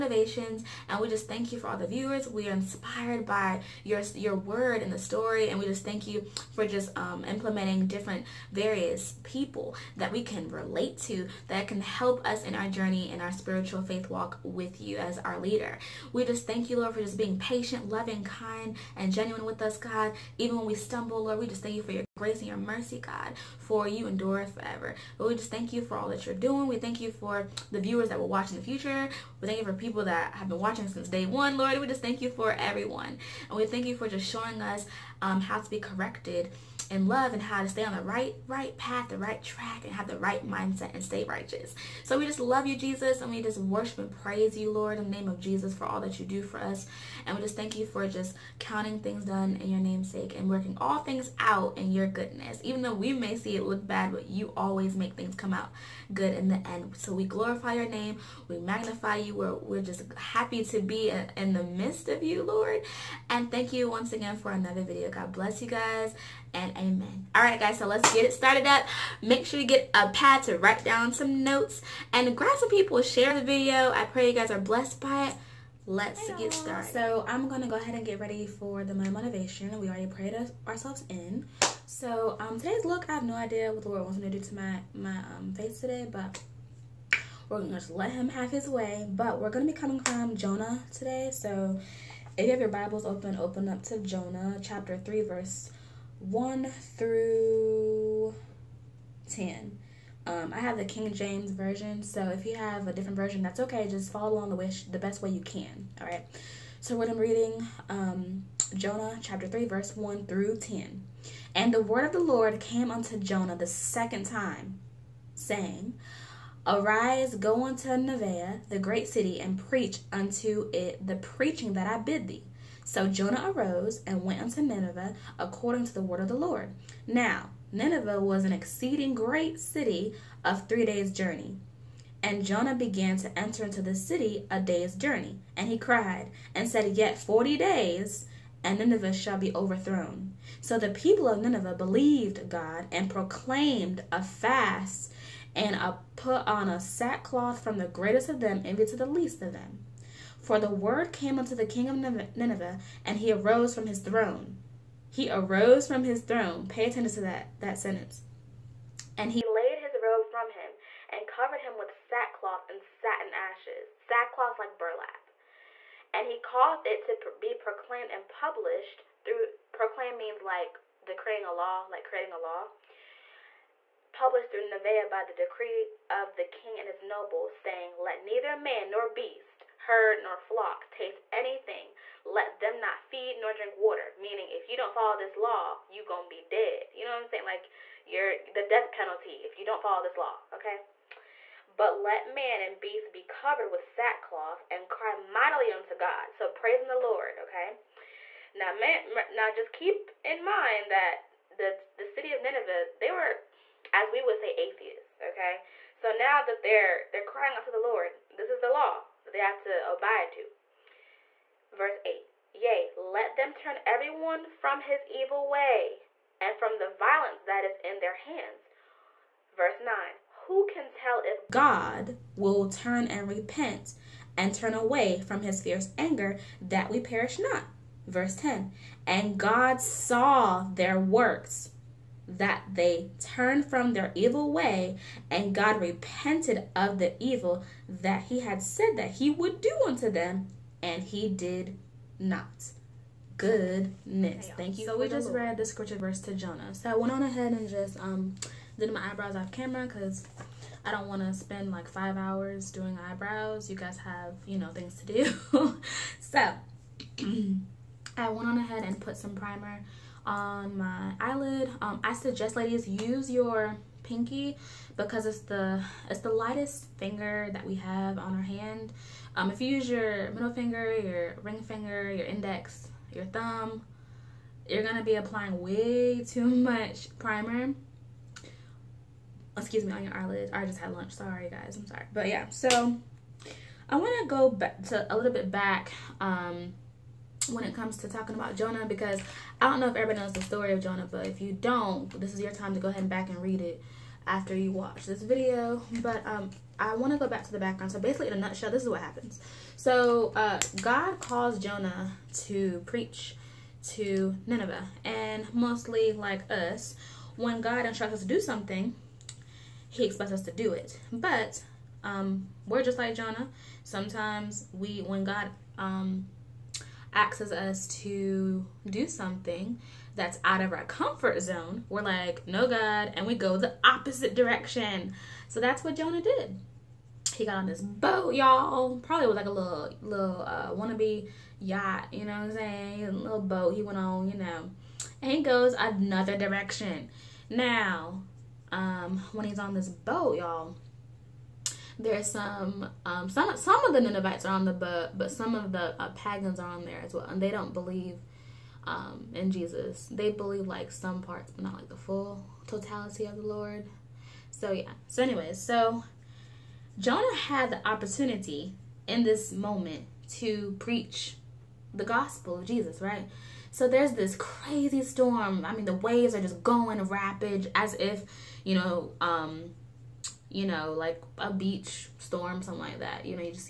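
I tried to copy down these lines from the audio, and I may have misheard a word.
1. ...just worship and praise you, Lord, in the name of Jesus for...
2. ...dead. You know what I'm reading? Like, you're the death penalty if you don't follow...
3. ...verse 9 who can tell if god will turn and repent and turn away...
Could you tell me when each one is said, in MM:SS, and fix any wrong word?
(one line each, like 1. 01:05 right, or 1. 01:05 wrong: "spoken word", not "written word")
1. 00:43 right
2. 03:06 wrong: "saying", not "reading"
3. 03:39 right.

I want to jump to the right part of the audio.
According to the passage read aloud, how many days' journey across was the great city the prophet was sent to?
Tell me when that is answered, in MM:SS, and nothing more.
02:10.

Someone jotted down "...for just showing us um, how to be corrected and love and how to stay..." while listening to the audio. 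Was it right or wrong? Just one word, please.
right.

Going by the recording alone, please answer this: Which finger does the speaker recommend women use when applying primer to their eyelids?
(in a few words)
Pinky.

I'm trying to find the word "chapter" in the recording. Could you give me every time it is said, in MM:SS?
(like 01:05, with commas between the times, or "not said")
01:34, 01:49.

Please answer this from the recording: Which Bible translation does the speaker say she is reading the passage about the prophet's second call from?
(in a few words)
King James version.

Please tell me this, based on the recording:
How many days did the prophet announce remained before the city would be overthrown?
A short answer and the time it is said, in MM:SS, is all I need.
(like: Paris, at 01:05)
40, at 02:17.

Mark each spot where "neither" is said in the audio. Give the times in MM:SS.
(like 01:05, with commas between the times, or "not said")
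02:58.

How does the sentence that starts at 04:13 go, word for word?
You guys have, you know, things to do.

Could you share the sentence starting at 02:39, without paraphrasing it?
And he laid his robe from him, and covered him with sackcloth and satin ashes.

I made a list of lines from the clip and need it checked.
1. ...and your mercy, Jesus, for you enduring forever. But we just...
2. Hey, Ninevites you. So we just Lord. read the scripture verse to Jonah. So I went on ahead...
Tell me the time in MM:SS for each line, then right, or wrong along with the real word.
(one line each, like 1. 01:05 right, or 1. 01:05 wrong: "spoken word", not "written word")
1. 00:22 wrong: "God", not "Jesus"
2. 04:04 wrong: "Thank", not "Ninevites".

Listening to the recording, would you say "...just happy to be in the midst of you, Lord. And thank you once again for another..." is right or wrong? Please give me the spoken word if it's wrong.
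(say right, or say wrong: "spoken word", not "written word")
right.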